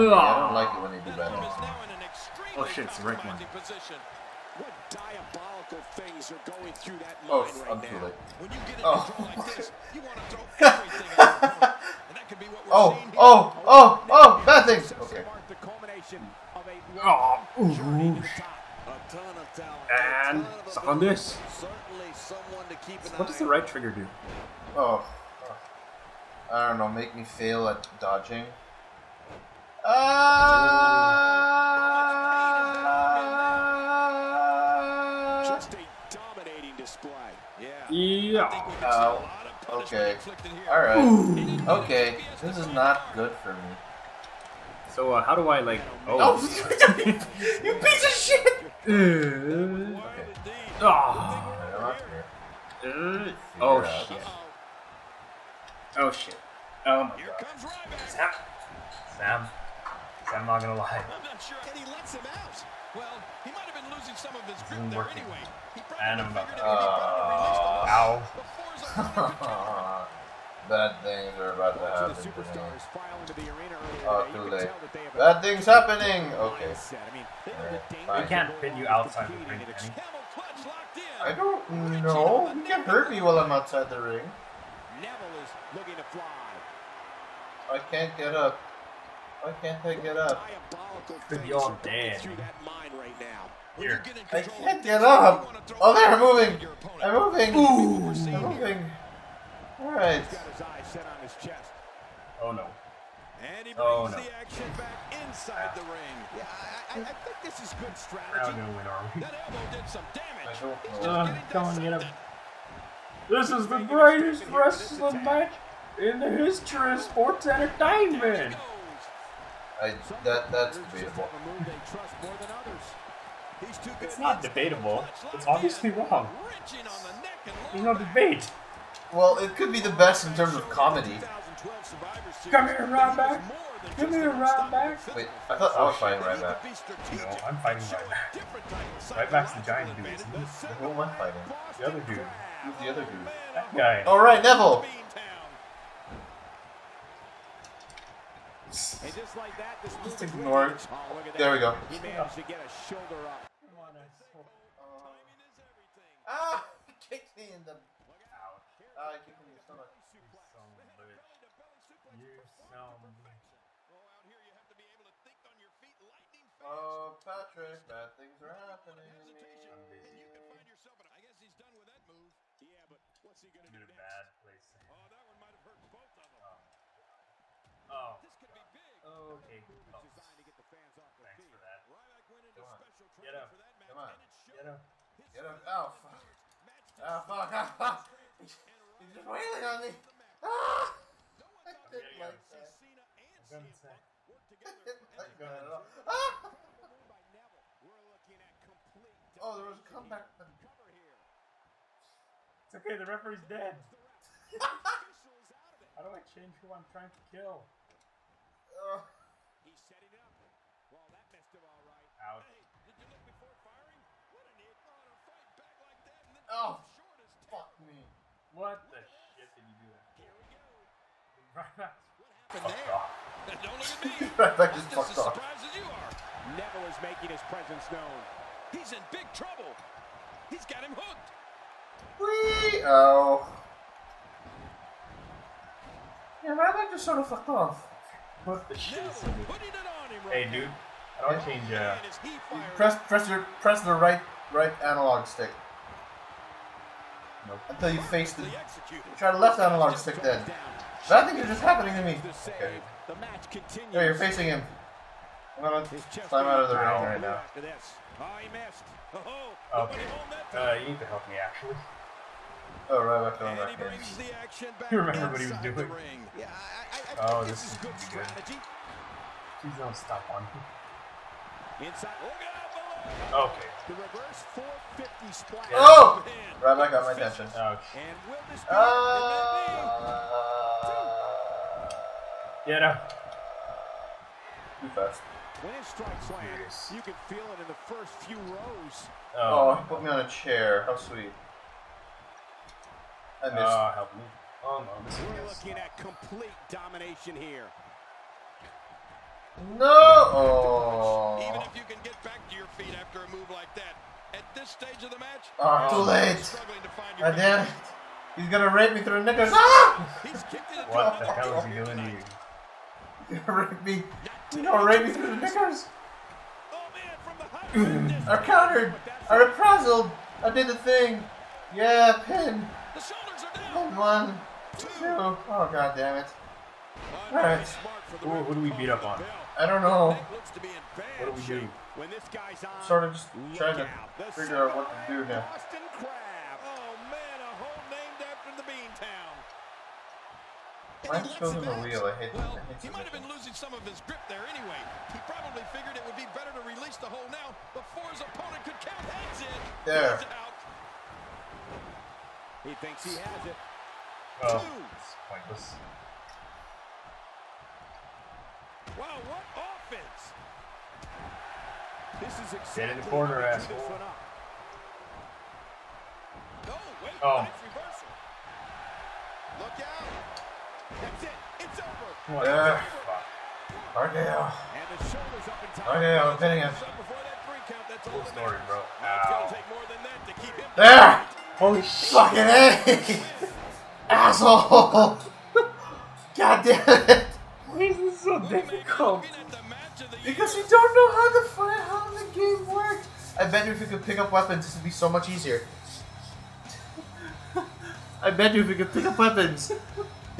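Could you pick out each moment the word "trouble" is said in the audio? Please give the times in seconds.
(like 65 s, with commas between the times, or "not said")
229 s.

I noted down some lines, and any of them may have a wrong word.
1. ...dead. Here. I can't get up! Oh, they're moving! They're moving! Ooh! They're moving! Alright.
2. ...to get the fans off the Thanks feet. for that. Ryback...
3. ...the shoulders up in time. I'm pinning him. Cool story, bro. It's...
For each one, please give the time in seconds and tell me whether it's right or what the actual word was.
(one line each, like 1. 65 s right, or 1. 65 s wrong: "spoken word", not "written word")
1. 91 s right
2. 180 s right
3. 374 s right.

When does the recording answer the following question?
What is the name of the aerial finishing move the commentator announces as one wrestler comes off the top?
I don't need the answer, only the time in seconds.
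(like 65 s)
273 s.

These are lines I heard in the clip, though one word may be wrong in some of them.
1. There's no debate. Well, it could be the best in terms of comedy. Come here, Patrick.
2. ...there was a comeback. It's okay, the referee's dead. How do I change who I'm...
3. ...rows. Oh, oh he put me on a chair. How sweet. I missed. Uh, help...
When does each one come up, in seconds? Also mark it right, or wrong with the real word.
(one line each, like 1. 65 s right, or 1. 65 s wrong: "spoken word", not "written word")
1. 127 s wrong: "Ryback", not "Patrick"
2. 199 s right
3. 288 s right.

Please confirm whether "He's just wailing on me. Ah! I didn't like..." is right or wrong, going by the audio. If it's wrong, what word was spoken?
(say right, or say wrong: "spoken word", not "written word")
right.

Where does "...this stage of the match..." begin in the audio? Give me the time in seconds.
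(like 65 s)
304 s.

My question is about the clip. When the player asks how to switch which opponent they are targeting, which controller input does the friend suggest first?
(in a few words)
right analog stick.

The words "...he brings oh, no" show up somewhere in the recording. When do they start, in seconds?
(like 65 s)
103 s.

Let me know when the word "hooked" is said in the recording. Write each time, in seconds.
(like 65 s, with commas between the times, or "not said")
230 s.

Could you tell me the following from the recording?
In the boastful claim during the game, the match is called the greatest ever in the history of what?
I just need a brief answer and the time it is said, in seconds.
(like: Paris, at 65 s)
sports entertainment, at 117 s.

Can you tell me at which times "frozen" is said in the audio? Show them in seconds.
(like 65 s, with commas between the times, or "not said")
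not said.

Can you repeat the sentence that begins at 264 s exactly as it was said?
You remember what he was doing?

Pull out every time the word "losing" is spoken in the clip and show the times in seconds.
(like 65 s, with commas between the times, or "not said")
63 s, 343 s.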